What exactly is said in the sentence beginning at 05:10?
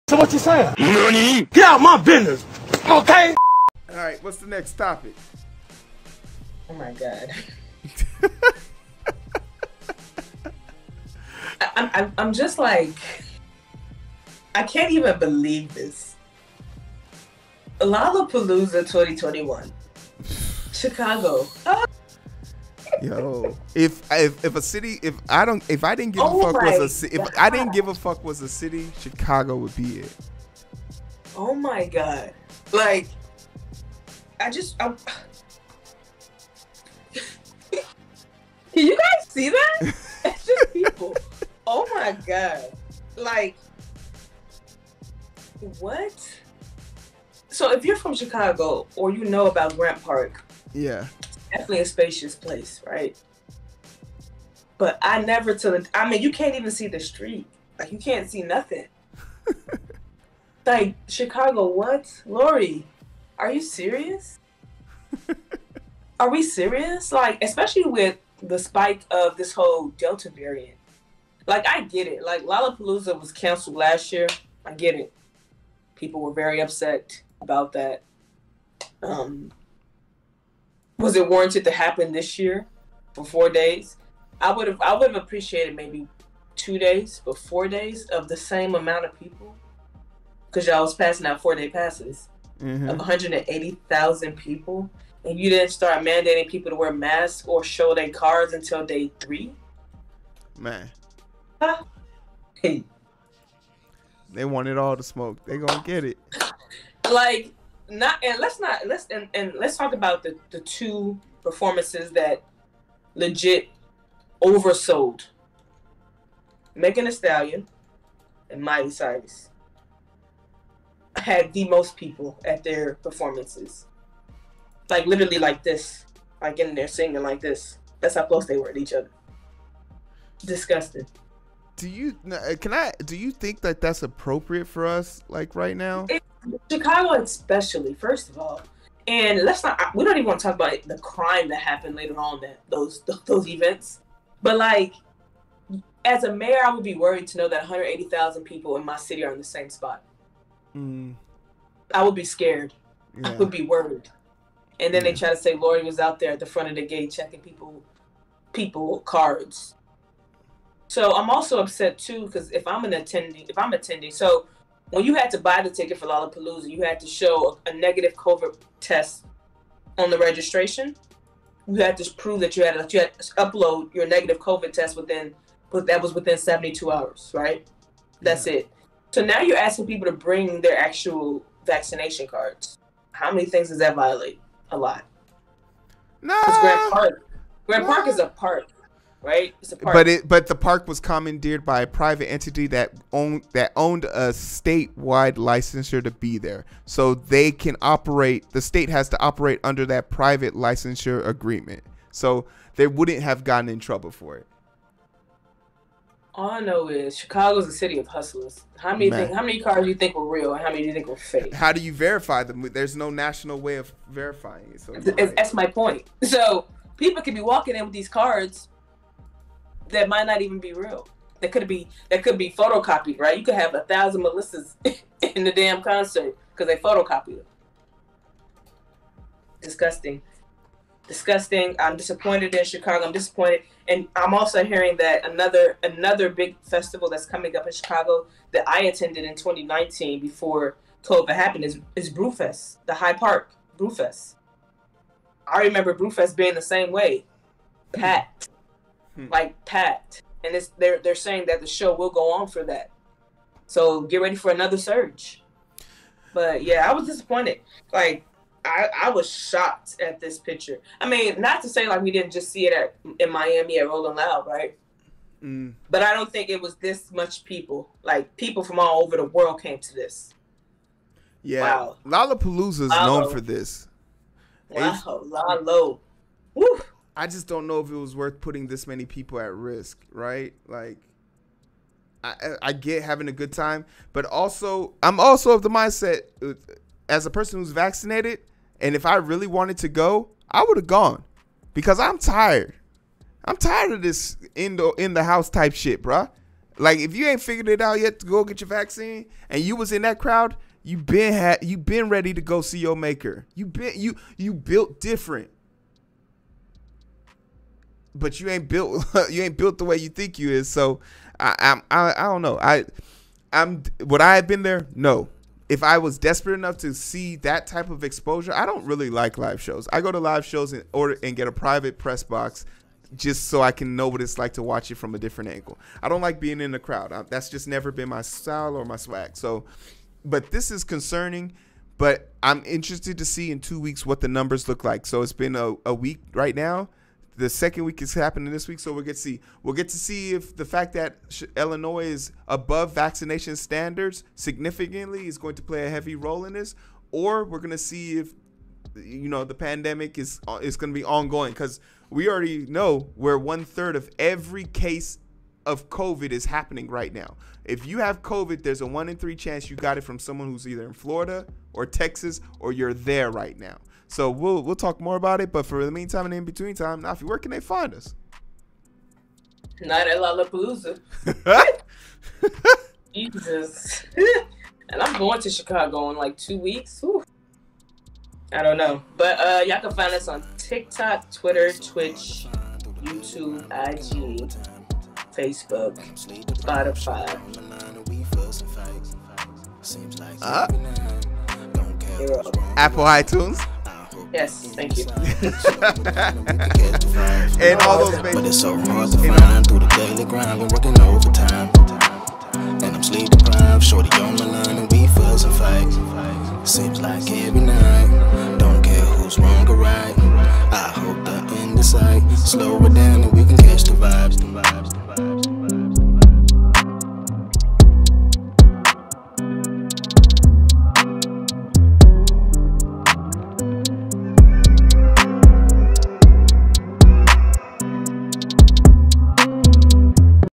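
So I, i I, I don't know.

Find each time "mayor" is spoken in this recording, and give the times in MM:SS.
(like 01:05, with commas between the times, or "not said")
02:26.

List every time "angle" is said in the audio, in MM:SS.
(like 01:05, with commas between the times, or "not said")
05:25.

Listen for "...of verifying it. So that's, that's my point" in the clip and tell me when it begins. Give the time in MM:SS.
03:33.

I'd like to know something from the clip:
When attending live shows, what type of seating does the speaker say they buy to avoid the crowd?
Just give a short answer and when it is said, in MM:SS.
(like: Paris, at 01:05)
private press box, at 05:21.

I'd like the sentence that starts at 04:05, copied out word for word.
I remember Brewfest being the same way, packed.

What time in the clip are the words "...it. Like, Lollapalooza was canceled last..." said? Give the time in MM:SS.
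01:12.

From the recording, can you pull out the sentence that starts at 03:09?
But it but the park was commandeered by a private entity that owned that owned a statewide licensure to be there.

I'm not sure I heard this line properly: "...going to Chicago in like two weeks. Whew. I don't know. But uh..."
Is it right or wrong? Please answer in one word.
right.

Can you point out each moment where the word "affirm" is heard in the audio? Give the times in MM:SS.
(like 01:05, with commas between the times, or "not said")
not said.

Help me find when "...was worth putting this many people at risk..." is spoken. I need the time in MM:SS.
04:37.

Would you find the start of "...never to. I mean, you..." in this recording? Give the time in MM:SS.
00:55.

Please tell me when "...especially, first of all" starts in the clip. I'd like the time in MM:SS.
02:17.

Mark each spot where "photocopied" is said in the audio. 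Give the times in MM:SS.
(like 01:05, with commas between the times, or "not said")
03:42, 03:46.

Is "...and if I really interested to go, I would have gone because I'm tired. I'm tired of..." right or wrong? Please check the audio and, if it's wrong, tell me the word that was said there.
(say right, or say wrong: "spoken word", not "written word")
wrong: "wanted", not "interested".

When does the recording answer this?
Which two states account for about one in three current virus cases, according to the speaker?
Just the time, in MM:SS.
06:00.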